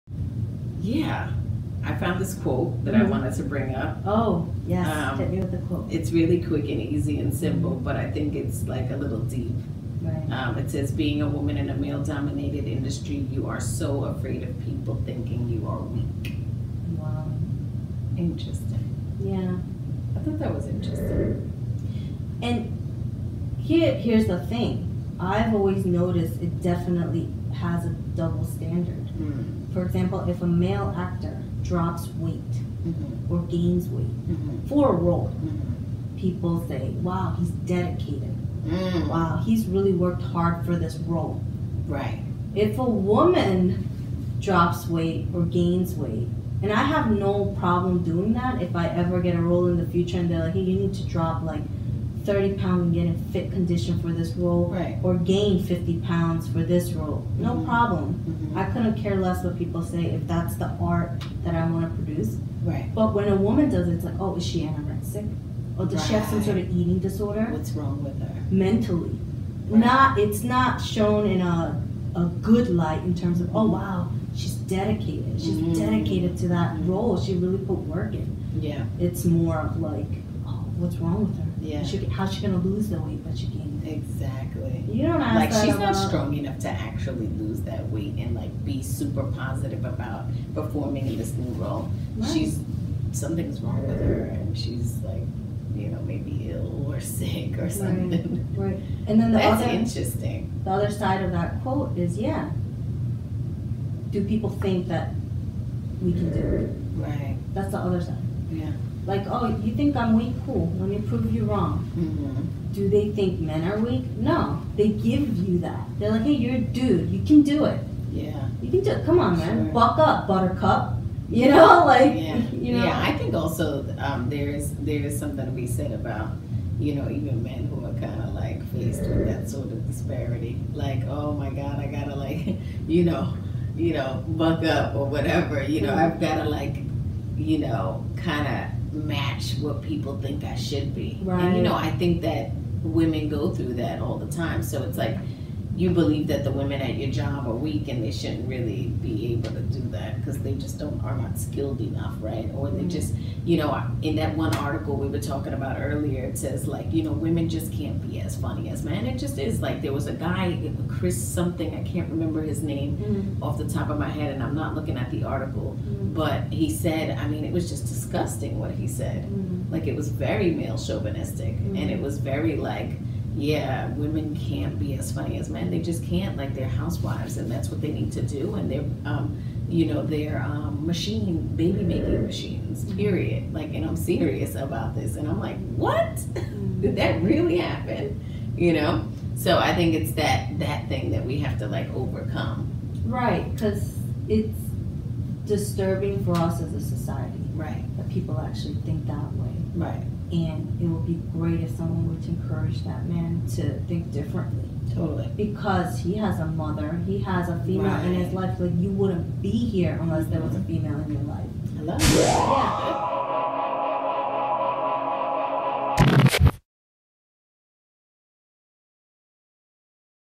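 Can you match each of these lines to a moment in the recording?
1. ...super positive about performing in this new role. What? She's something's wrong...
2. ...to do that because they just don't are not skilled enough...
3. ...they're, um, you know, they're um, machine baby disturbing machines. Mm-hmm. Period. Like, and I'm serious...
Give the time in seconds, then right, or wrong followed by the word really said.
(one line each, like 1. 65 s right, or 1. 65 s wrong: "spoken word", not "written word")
1. 88 s right
2. 149 s right
3. 178 s wrong: "making", not "disturbing".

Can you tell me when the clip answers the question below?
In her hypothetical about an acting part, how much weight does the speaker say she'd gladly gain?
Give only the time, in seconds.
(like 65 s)
55 s.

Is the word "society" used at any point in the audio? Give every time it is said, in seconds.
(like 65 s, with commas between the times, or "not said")
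196 s.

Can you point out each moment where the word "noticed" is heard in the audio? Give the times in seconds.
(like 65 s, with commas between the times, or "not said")
25 s.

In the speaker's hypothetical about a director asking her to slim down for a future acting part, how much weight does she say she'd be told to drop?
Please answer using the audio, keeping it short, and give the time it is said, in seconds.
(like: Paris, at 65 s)
30 pounds, at 52 s.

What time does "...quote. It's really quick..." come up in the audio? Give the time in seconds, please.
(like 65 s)
5 s.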